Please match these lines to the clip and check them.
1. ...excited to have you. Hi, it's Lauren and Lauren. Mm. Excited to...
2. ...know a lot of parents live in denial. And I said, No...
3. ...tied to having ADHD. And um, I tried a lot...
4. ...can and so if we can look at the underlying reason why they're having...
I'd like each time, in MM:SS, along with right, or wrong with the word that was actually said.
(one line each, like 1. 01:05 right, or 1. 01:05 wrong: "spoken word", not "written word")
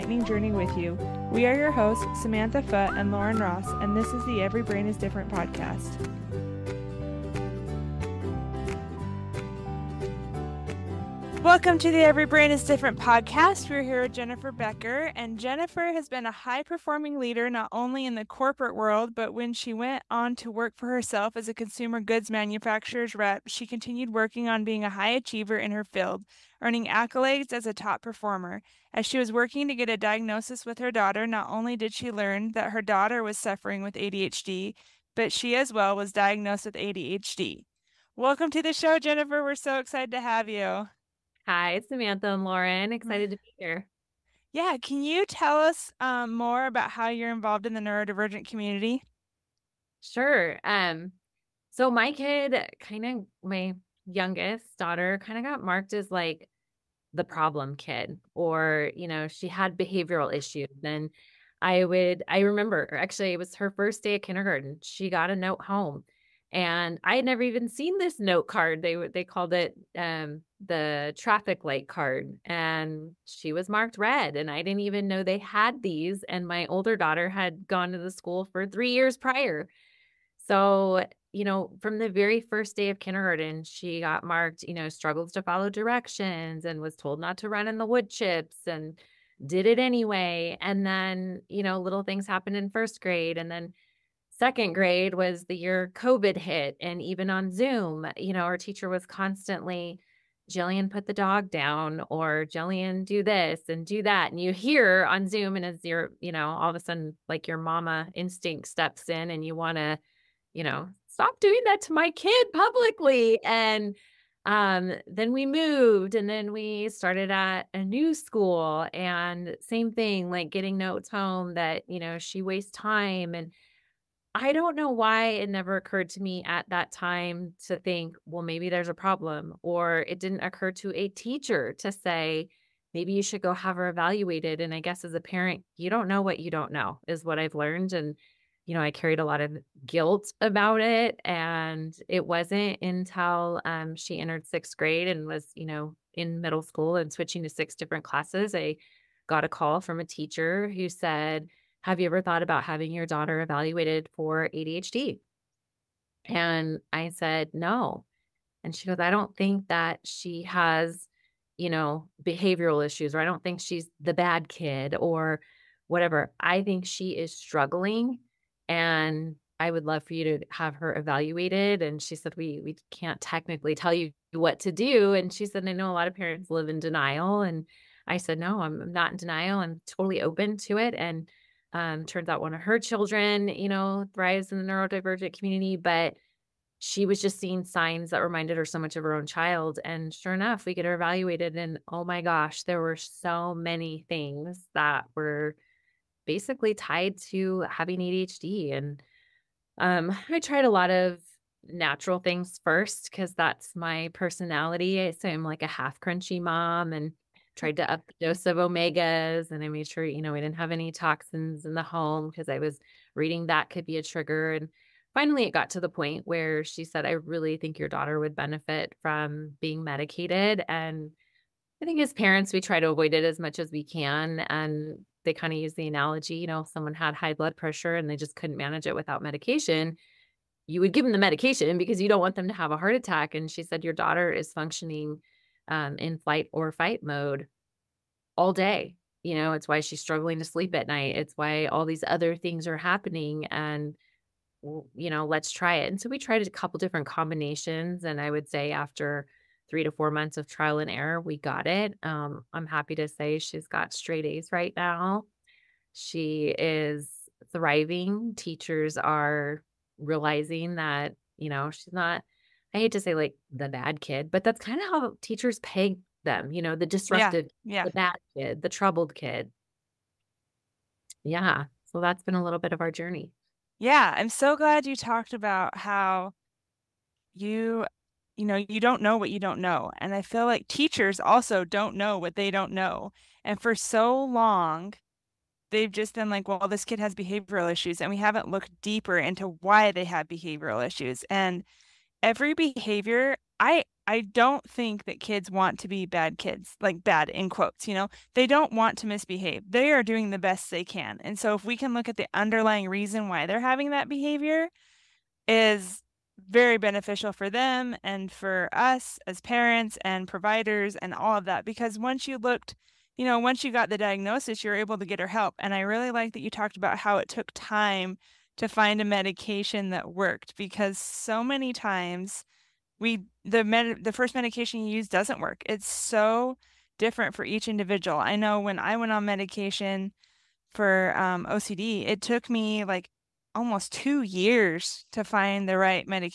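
1. 00:39 wrong: "Samantha", not "Lauren"
2. 02:55 right
3. 03:16 right
4. 05:00 right.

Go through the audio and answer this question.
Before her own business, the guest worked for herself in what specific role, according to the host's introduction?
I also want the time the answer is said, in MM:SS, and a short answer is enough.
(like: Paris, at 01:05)
Consumer goods manufacturer's rep, at 00:21.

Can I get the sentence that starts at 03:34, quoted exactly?
And finally, it got to the point where she said, I really think your daughter would benefit from being medicated.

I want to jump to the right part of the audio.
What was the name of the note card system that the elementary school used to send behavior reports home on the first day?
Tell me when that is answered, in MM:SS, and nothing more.
01:11.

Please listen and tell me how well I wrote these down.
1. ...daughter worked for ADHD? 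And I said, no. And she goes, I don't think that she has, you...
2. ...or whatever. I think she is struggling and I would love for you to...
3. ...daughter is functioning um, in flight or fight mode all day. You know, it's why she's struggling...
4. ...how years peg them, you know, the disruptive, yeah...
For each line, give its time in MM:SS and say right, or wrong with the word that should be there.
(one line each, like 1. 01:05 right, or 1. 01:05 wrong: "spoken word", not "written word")
1. 02:33 wrong: "evaluated", not "worked"
2. 02:44 right
3. 03:53 right
4. 04:24 wrong: "teachers", not "years".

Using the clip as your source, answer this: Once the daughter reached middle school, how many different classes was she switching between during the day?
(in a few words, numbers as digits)
6.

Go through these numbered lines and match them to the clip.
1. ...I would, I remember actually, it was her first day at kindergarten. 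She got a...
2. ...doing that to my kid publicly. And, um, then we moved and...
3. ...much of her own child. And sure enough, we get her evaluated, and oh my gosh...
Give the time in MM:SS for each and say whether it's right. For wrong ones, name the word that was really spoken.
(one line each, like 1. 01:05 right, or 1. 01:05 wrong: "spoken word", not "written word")
1. 01:01 right
2. 01:51 right
3. 03:08 right.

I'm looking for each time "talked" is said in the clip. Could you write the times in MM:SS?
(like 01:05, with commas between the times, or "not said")
04:34, 05:16.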